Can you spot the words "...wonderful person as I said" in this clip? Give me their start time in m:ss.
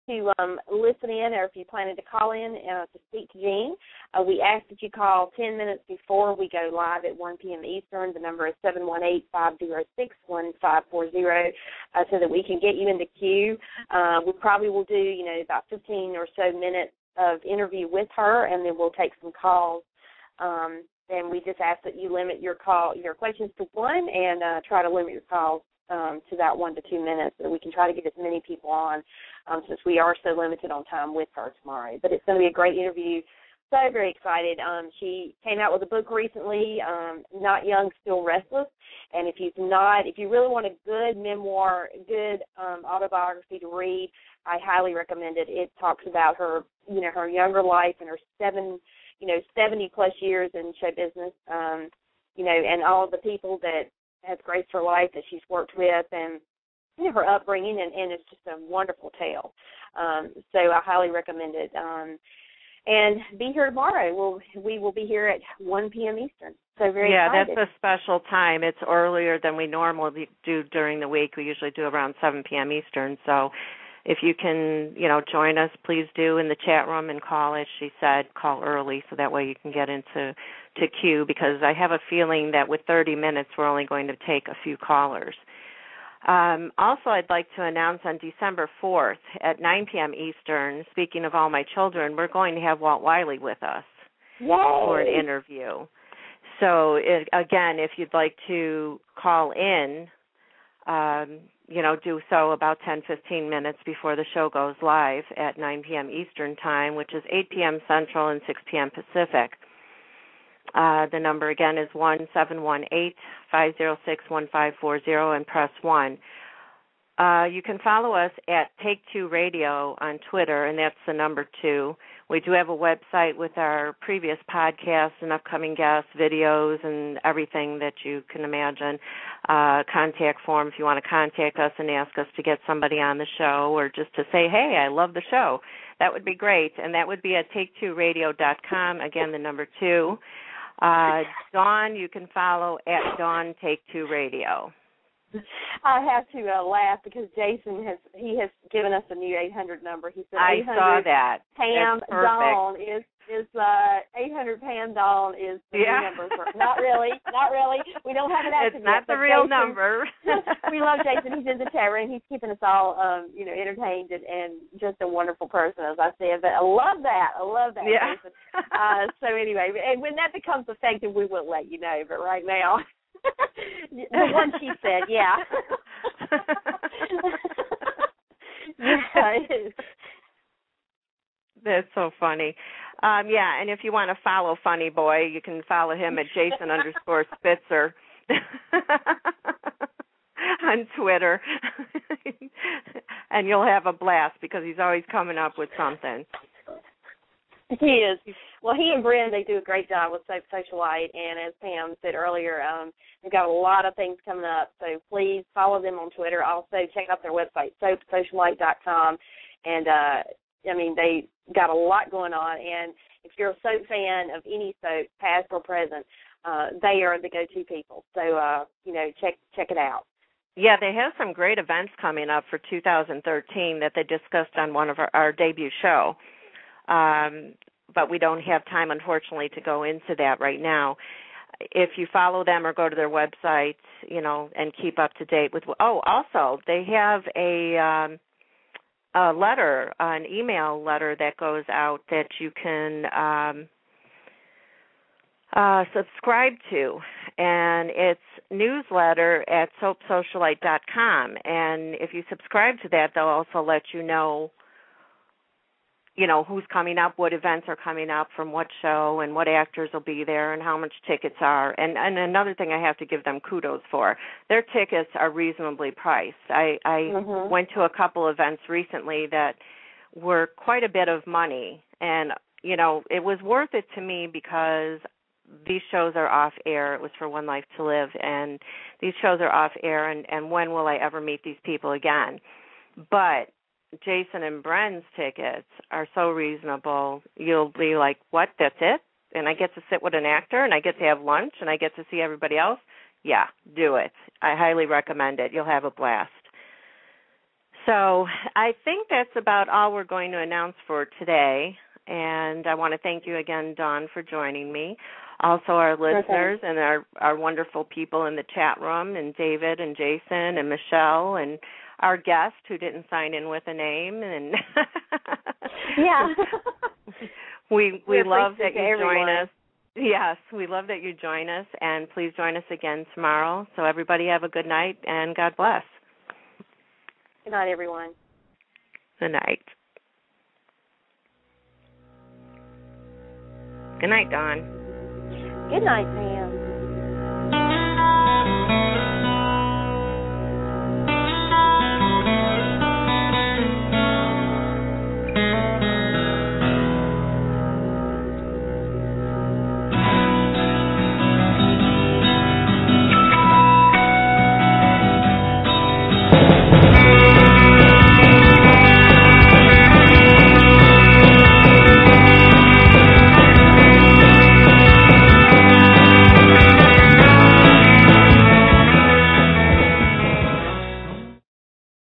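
2:45.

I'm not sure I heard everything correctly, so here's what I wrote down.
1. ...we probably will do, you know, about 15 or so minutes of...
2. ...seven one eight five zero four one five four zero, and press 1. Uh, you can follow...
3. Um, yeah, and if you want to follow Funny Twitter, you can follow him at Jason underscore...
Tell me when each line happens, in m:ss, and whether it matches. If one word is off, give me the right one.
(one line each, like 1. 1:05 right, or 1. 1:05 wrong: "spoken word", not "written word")
1. 0:14 right
2. 1:52 wrong: "six", not "four"
3. 3:03 wrong: "Boy", not "Twitter".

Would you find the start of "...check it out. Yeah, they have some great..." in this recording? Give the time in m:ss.
3:39.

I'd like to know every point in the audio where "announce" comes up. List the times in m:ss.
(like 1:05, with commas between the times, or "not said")
1:27, 5:00.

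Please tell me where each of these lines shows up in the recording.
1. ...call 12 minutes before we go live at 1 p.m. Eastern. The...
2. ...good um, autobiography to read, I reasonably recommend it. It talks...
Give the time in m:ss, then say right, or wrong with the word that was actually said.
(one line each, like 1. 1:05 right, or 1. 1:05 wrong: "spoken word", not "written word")
1. 0:04 wrong: "10", not "12"
2. 0:42 wrong: "highly", not "reasonably".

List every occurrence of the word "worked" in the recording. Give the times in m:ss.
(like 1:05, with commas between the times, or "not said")
0:55.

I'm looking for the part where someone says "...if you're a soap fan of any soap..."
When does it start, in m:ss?
3:33.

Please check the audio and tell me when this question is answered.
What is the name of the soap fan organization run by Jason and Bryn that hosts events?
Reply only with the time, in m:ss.
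3:20.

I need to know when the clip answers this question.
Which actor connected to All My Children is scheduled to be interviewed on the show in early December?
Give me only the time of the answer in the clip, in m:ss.
1:32.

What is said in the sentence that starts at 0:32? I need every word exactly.
But it's going to be a great interview.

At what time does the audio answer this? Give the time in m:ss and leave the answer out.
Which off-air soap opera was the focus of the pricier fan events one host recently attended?
4:37.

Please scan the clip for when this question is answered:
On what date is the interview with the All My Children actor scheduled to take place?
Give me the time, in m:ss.
1:28.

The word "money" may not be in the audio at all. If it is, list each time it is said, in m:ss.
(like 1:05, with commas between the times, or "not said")
4:31.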